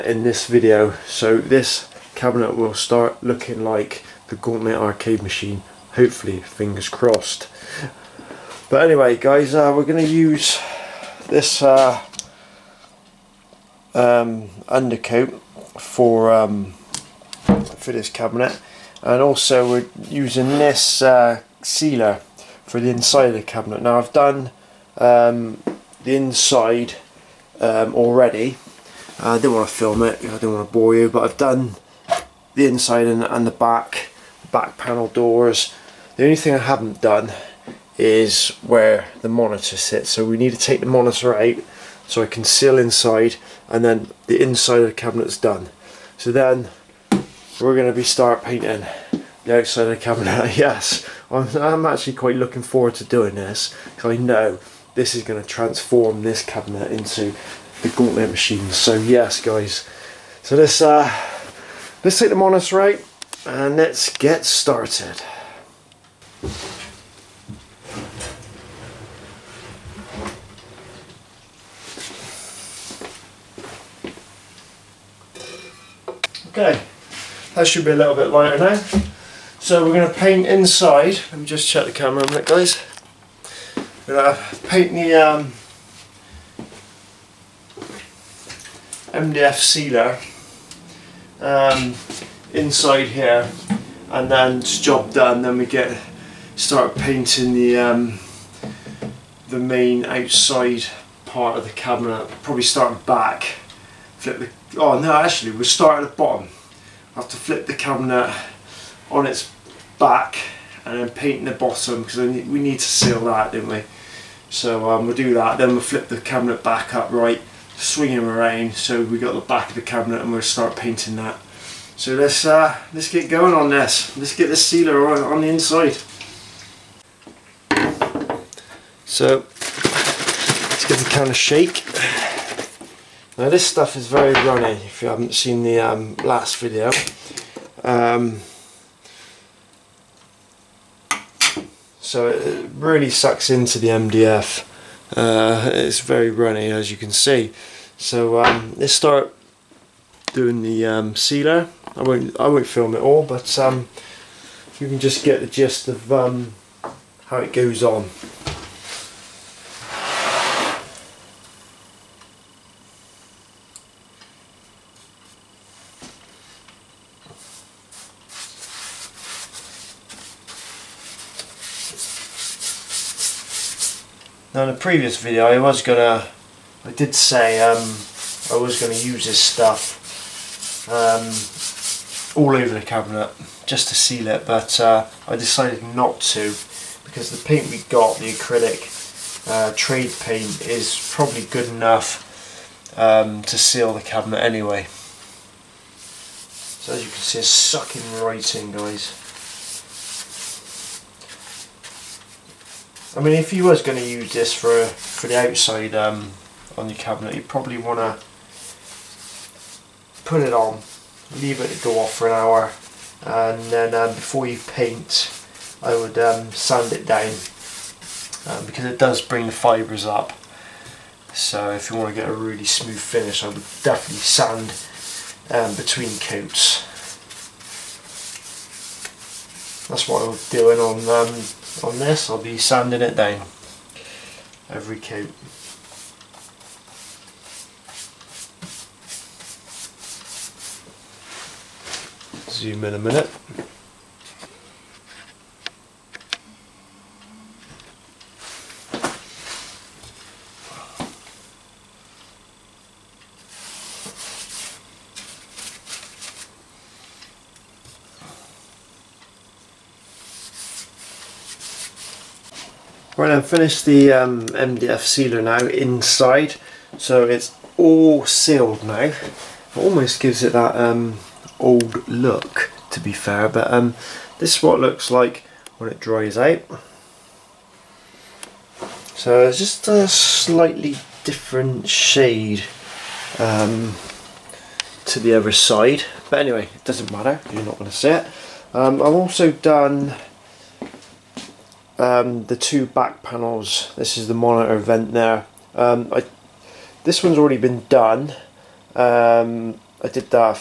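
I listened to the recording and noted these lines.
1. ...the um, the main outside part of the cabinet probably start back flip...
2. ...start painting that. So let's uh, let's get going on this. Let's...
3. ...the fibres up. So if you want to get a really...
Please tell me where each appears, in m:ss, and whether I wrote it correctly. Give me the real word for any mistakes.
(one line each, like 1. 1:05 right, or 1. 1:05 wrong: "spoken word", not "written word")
1. 1:37 right
2. 2:00 right
3. 3:39 right.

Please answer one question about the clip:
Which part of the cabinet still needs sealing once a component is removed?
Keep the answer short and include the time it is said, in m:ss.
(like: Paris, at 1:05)
where the monitor sits, at 0:38.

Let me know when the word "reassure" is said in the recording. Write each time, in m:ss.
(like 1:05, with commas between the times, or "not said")
not said.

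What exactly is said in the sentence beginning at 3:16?
So as you can see it's sucking right in guys.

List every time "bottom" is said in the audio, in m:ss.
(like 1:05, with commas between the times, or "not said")
1:46, 1:51.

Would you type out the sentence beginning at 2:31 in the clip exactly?
I won't I won't film it all, but um, you can just get the gist of um, how it goes on.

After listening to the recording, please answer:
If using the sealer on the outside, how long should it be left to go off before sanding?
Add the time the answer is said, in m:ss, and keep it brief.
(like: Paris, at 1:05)
an hour, at 3:32.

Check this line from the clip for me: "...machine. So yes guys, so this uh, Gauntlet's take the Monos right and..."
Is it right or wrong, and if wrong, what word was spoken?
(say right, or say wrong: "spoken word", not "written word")
wrong: "Let", not "Gauntlet".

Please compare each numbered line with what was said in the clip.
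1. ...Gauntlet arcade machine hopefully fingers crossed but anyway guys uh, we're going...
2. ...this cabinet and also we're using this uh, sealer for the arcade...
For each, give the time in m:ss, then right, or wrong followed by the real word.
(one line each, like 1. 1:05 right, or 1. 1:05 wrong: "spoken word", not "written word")
1. 0:04 right
2. 0:17 wrong: "inside", not "arcade".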